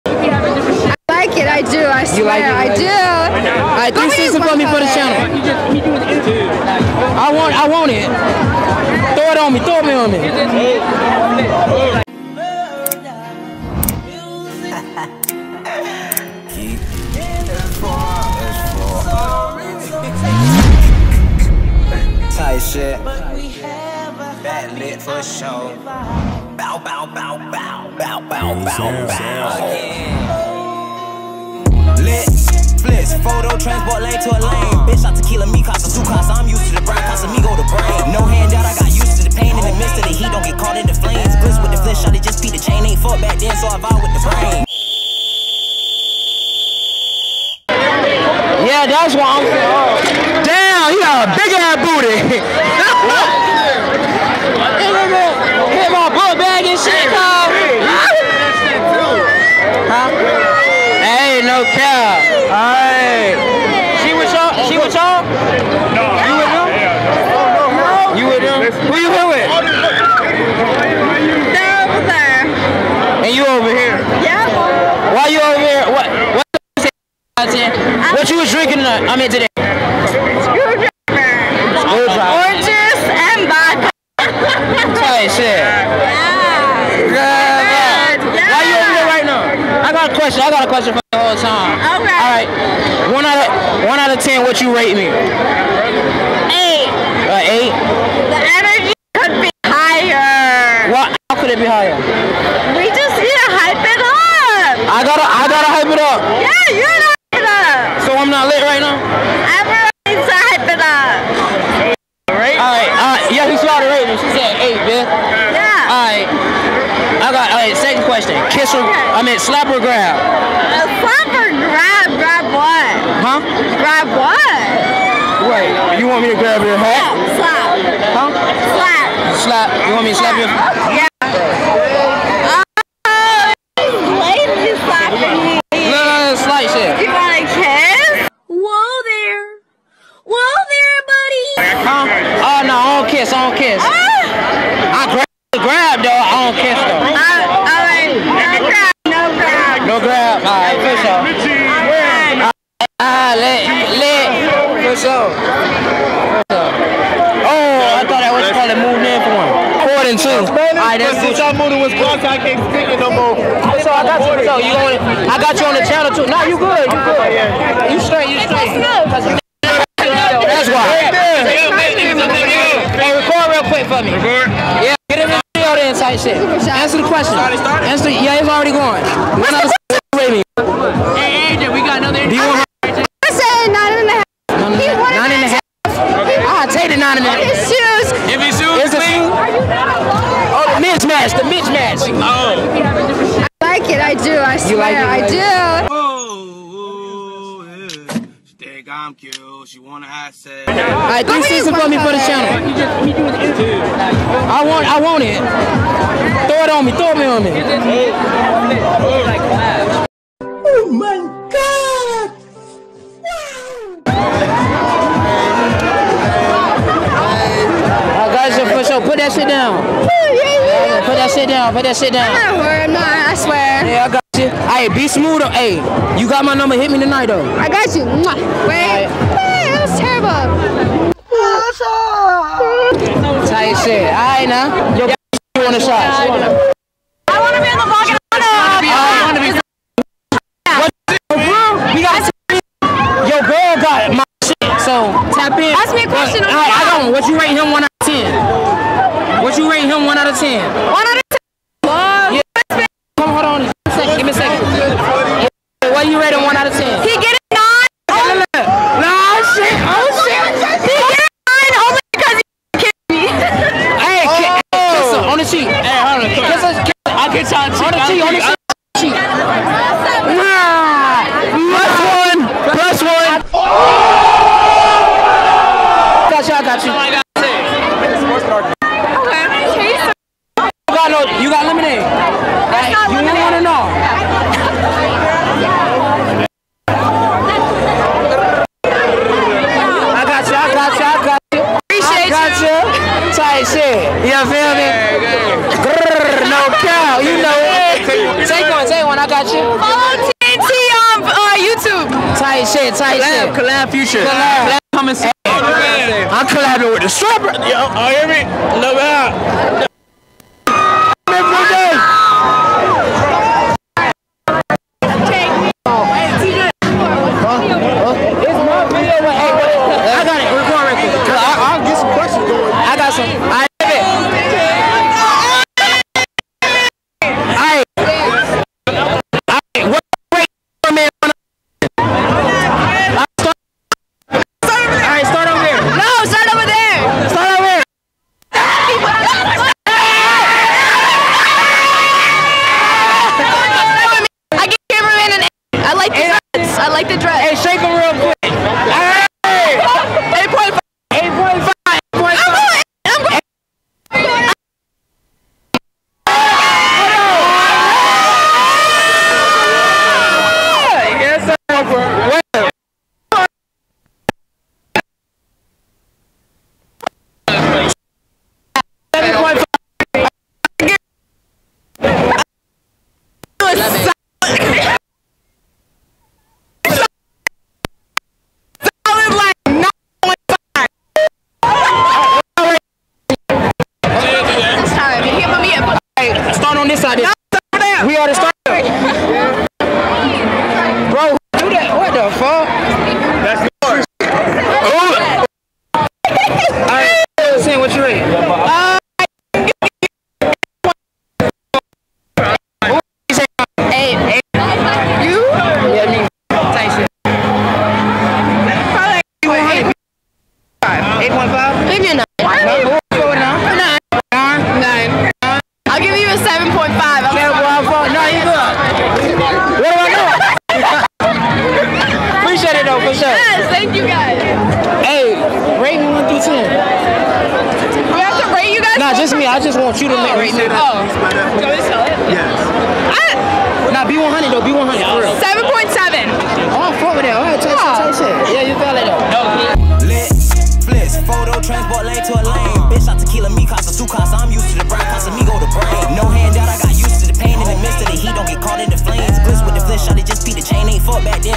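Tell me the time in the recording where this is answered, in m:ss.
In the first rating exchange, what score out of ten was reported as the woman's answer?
1:54.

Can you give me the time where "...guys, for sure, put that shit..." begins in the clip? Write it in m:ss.
3:38.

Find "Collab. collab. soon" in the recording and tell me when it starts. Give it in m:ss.
5:04.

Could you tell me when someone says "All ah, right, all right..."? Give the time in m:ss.
2:31.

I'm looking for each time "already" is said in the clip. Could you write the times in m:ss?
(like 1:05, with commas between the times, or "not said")
2:58.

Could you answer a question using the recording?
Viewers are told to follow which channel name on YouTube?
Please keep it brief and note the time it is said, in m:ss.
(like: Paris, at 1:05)
TNT, at 5:00.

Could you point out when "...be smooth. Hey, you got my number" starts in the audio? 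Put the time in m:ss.
3:44.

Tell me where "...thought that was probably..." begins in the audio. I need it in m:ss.
2:38.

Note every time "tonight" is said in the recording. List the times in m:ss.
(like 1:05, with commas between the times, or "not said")
1:18, 3:46.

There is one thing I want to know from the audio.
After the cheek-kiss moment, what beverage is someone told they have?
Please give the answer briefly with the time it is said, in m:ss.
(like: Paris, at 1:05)
Lemonade, at 4:41.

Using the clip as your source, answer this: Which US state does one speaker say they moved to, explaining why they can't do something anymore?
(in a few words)
Wisconsin.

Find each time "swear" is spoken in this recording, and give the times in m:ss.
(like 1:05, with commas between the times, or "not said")
0:02, 3:14, 3:43.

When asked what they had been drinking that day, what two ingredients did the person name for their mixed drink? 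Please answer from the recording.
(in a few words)
Oranges and vodka.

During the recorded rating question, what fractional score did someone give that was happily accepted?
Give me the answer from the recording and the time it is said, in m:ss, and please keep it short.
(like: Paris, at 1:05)
9.5, at 3:03.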